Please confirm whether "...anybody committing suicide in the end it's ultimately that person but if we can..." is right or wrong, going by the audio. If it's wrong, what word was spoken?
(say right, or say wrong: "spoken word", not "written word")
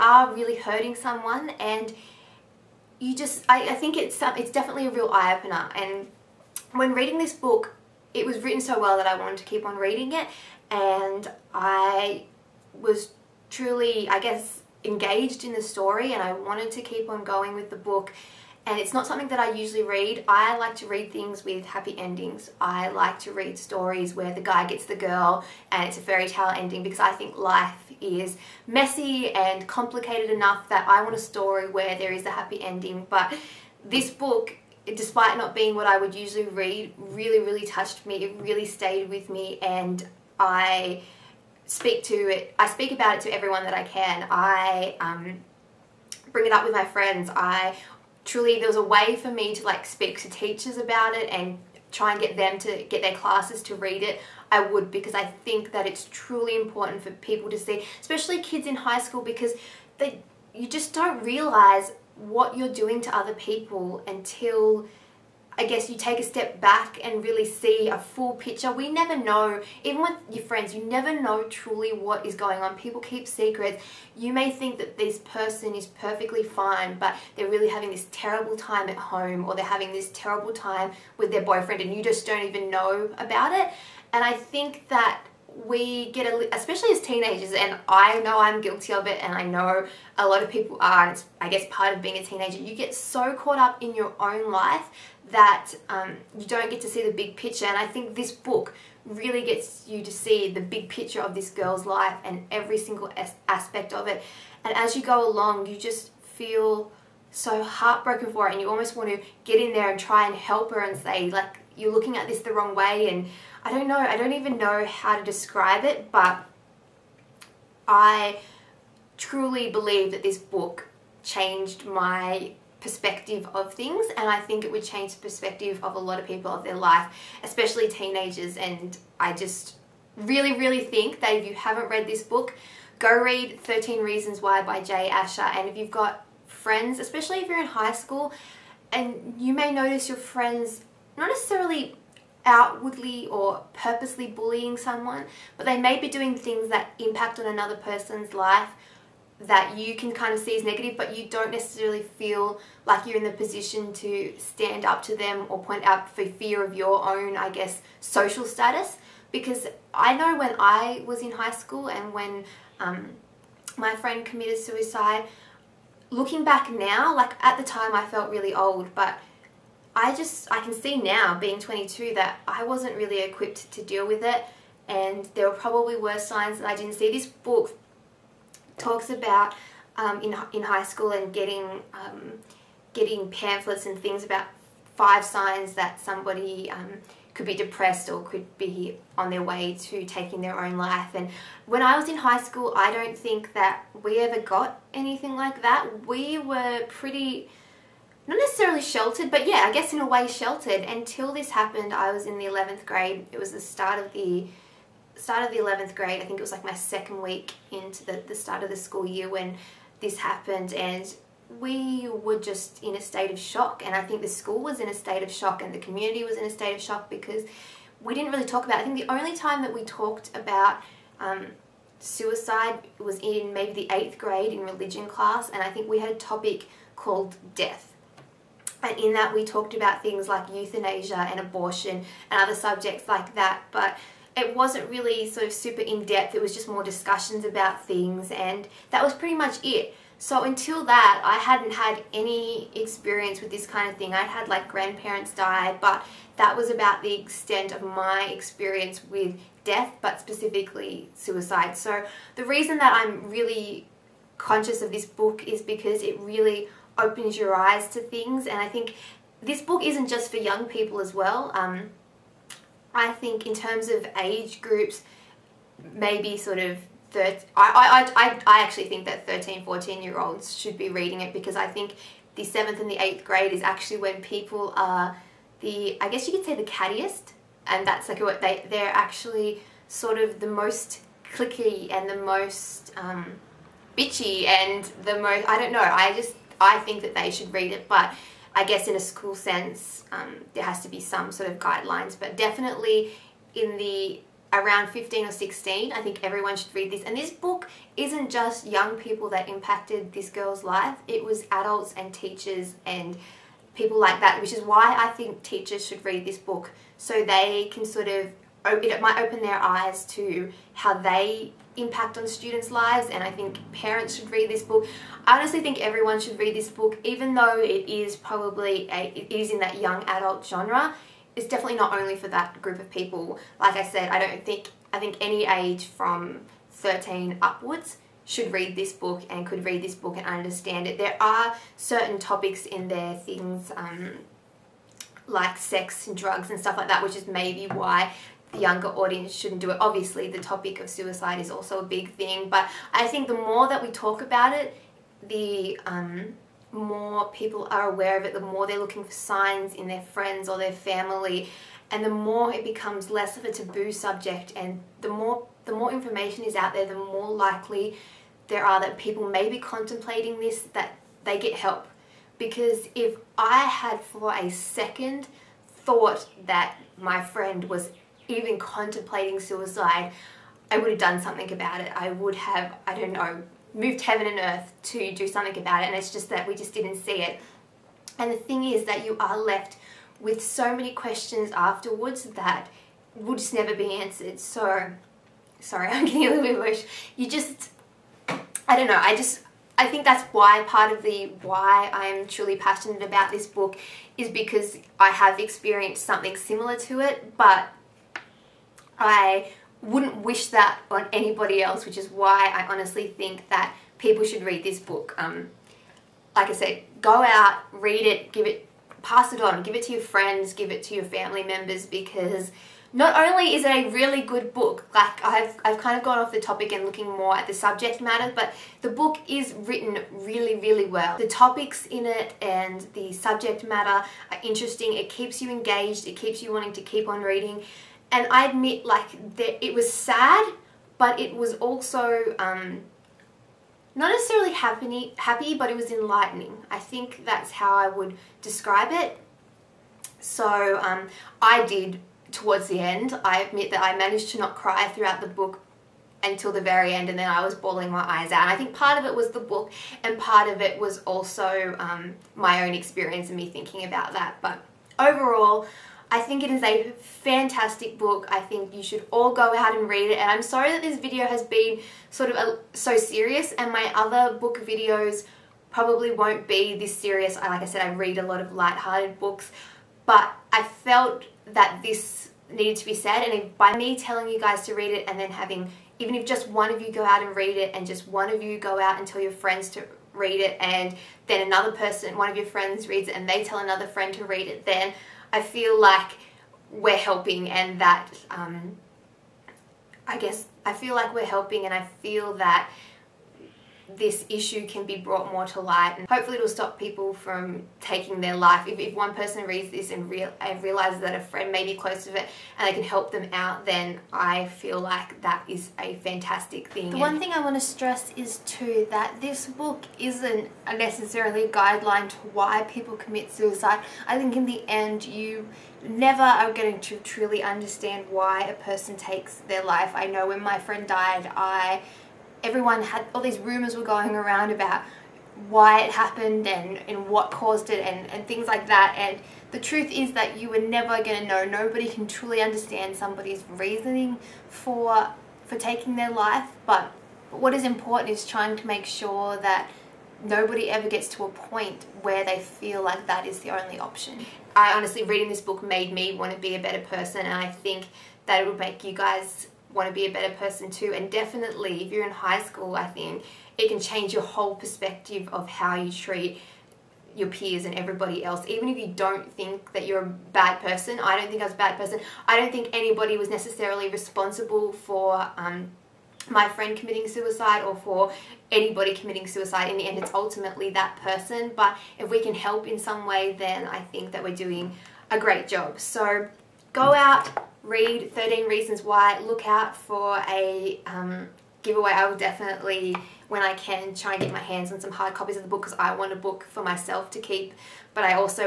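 right.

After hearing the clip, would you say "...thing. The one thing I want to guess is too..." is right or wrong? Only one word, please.
wrong.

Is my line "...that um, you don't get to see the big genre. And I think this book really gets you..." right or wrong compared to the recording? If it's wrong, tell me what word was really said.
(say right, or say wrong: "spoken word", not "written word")
wrong: "picture", not "genre".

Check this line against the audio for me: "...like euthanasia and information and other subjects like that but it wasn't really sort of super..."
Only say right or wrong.
wrong.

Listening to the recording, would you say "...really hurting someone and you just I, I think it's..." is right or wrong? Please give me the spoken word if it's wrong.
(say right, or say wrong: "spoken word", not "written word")
right.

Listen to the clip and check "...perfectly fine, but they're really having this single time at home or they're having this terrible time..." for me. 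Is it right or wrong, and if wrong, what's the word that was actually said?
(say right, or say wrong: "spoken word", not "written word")
wrong: "terrible", not "single".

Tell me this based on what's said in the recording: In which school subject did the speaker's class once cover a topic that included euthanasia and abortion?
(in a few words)
Religion.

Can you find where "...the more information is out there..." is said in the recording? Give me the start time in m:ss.
5:55.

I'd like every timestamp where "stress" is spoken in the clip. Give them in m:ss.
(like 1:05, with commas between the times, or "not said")
8:27.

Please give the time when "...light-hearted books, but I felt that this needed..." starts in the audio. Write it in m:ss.
7:48.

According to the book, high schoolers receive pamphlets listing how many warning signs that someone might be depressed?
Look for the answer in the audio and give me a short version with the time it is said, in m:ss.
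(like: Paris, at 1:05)
5, at 3:04.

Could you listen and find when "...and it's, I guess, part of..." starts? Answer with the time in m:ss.
1:31.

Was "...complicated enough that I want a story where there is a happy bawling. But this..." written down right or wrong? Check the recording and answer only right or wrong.
wrong.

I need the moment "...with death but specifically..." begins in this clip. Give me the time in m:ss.
4:09.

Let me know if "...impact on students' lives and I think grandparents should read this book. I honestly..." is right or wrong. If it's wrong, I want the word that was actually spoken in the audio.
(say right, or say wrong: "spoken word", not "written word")
wrong: "parents", not "grandparents".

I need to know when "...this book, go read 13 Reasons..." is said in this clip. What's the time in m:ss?
2:12.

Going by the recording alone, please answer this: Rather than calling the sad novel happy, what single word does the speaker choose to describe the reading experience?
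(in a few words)
Enlightening.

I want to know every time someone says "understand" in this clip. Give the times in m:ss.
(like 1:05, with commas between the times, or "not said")
5:30, 8:37, 8:52.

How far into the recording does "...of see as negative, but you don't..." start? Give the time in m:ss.
2:30.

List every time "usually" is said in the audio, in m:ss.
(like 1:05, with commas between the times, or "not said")
0:19, 0:36.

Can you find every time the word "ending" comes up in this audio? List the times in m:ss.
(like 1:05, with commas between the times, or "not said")
0:21, 0:26, 0:32.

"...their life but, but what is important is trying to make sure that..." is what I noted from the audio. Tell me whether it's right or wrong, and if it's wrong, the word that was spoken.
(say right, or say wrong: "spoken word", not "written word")
right.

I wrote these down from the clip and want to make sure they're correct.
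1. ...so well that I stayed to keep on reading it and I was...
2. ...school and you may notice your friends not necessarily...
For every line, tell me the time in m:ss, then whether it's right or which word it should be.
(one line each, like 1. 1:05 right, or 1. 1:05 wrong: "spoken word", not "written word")
1. 0:08 wrong: "wanted", not "stayed"
2. 2:17 right.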